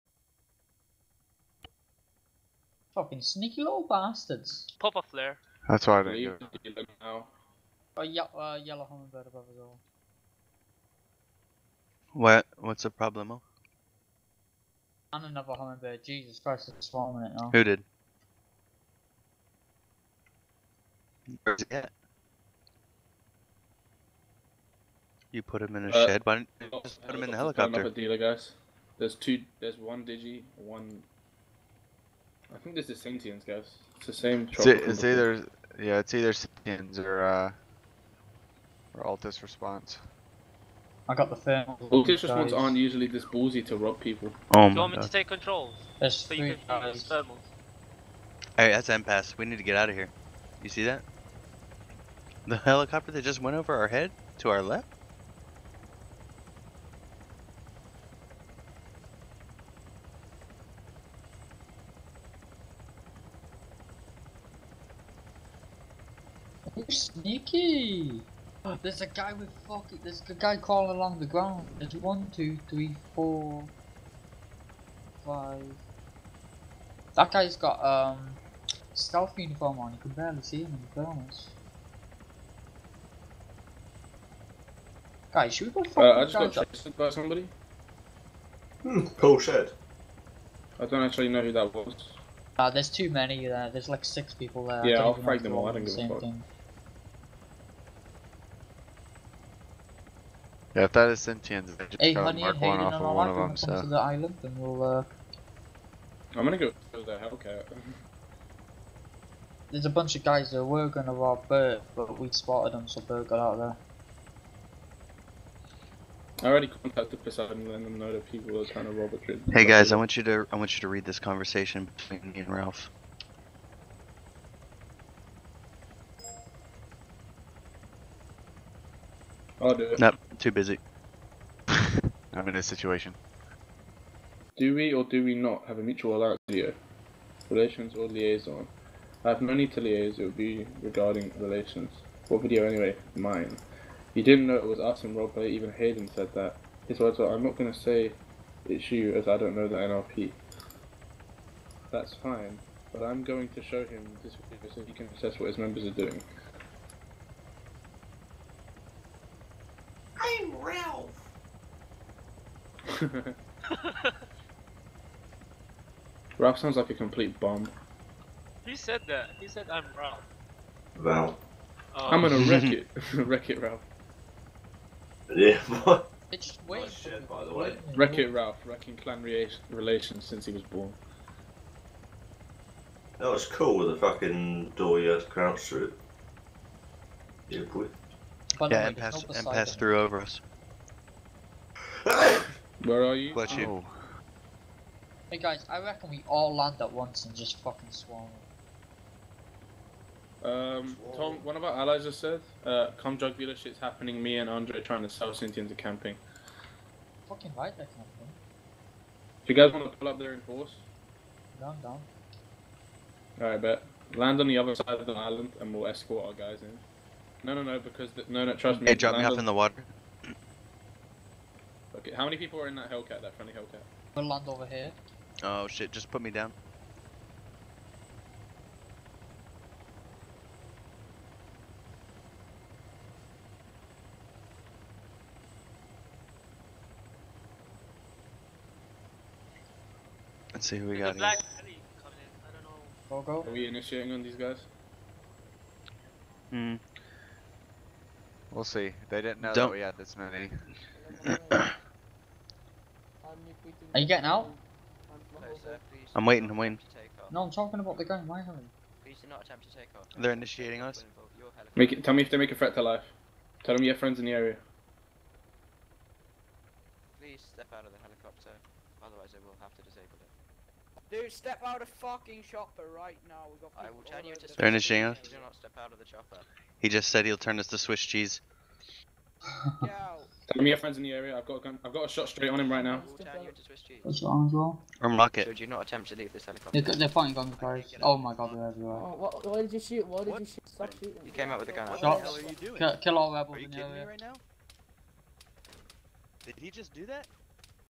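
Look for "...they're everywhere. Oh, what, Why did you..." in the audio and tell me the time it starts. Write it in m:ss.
4:48.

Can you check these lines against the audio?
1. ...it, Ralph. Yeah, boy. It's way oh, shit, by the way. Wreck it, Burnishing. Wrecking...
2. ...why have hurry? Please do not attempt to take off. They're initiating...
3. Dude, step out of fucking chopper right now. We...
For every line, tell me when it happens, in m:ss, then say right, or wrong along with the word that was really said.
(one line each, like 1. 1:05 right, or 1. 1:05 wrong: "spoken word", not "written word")
1. 2:53 wrong: "Ralph", not "Burnishing"
2. 4:18 right
3. 4:31 right.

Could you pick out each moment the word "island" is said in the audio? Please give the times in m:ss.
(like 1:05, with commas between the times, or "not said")
1:43, 3:35.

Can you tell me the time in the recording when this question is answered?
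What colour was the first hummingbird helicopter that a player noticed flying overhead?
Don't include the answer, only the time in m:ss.
0:08.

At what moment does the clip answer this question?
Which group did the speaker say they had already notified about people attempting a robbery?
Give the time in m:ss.
1:57.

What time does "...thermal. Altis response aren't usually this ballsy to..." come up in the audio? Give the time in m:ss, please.
0:41.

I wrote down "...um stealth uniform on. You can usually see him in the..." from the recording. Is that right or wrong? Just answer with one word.
wrong.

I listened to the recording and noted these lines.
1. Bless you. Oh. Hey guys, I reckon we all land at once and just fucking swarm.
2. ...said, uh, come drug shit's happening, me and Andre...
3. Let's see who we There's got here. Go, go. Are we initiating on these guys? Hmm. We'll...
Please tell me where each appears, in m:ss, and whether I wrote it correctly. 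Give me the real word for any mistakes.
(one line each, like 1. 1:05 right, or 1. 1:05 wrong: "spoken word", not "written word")
1. 3:13 right
2. 3:22 right
3. 4:00 right.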